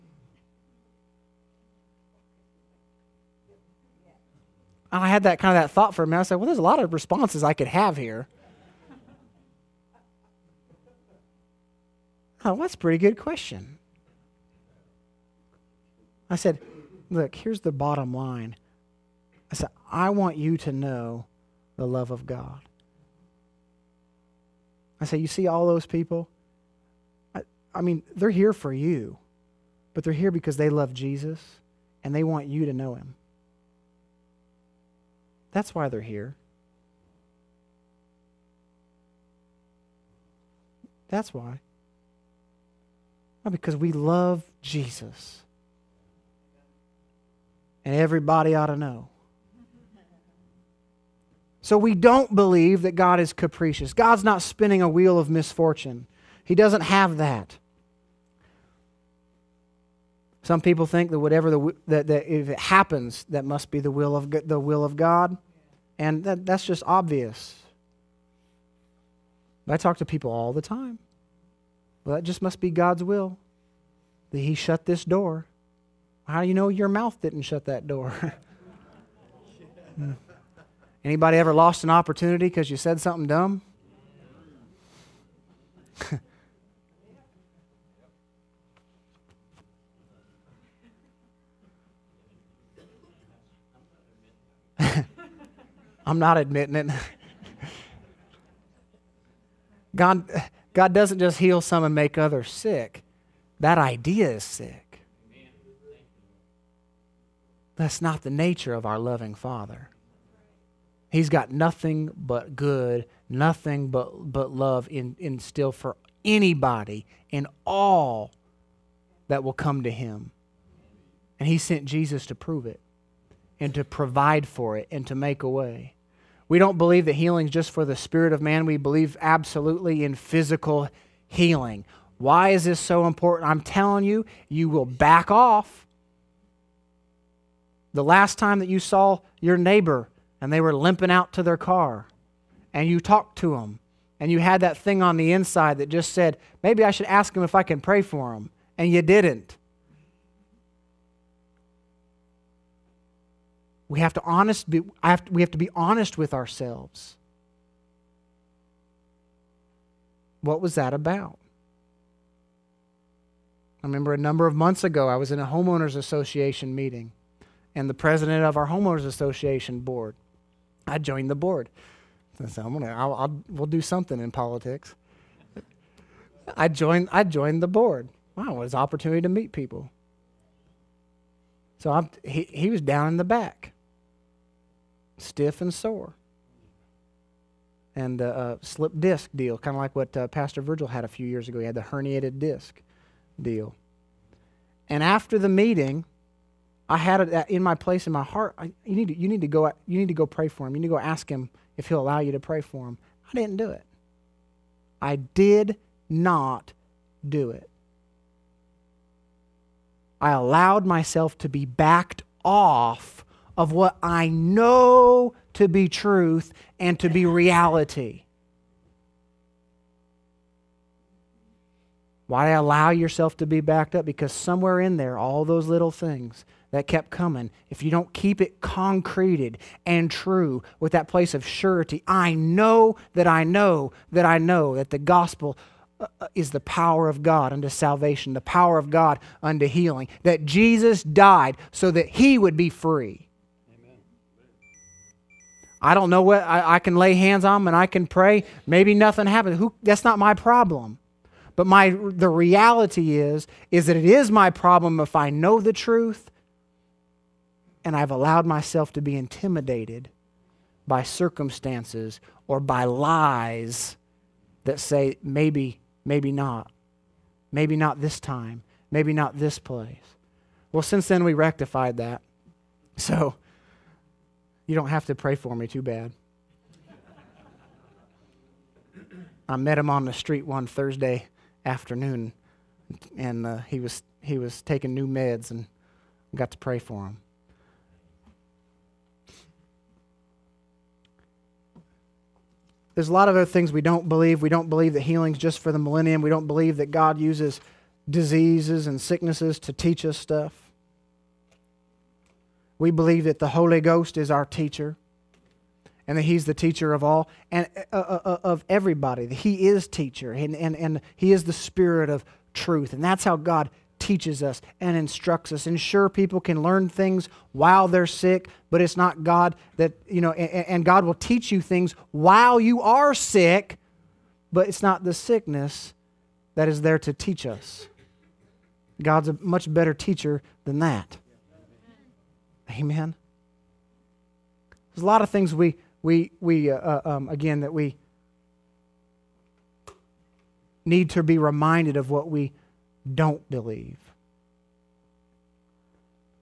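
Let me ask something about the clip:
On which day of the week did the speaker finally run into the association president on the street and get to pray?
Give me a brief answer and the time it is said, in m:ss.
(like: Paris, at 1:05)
Thursday, at 4:40.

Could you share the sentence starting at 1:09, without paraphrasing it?
I talk to people all the time.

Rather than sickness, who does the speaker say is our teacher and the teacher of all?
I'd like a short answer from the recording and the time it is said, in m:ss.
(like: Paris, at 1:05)
the Holy Ghost, at 5:03.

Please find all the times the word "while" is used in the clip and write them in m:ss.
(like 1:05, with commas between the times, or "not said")
5:17, 5:22.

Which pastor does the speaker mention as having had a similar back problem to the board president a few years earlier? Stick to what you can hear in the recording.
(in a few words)
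Virgil.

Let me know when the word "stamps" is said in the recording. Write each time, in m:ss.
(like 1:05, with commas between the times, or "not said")
not said.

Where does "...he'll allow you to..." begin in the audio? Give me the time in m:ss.
3:21.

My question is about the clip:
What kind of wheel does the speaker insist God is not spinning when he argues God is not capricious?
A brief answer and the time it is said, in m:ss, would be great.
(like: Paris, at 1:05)
wheel of misfortune, at 0:54.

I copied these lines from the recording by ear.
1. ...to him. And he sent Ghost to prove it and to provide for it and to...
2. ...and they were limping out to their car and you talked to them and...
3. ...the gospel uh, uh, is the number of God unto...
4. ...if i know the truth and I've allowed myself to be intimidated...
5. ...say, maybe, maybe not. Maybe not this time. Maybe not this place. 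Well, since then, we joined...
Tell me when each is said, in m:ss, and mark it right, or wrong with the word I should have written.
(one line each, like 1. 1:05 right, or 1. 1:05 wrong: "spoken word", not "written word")
1. 1:59 wrong: "Jesus", not "Ghost"
2. 2:20 right
3. 3:54 wrong: "power", not "number"
4. 4:14 right
5. 4:24 wrong: "rectified", not "joined".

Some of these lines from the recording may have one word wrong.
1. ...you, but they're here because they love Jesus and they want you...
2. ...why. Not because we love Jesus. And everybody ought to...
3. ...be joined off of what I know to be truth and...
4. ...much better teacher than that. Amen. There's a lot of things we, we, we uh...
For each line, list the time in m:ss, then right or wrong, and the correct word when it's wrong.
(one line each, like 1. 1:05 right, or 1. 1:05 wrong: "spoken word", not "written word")
1. 0:28 right
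2. 0:41 right
3. 3:31 wrong: "backed", not "joined"
4. 5:29 right.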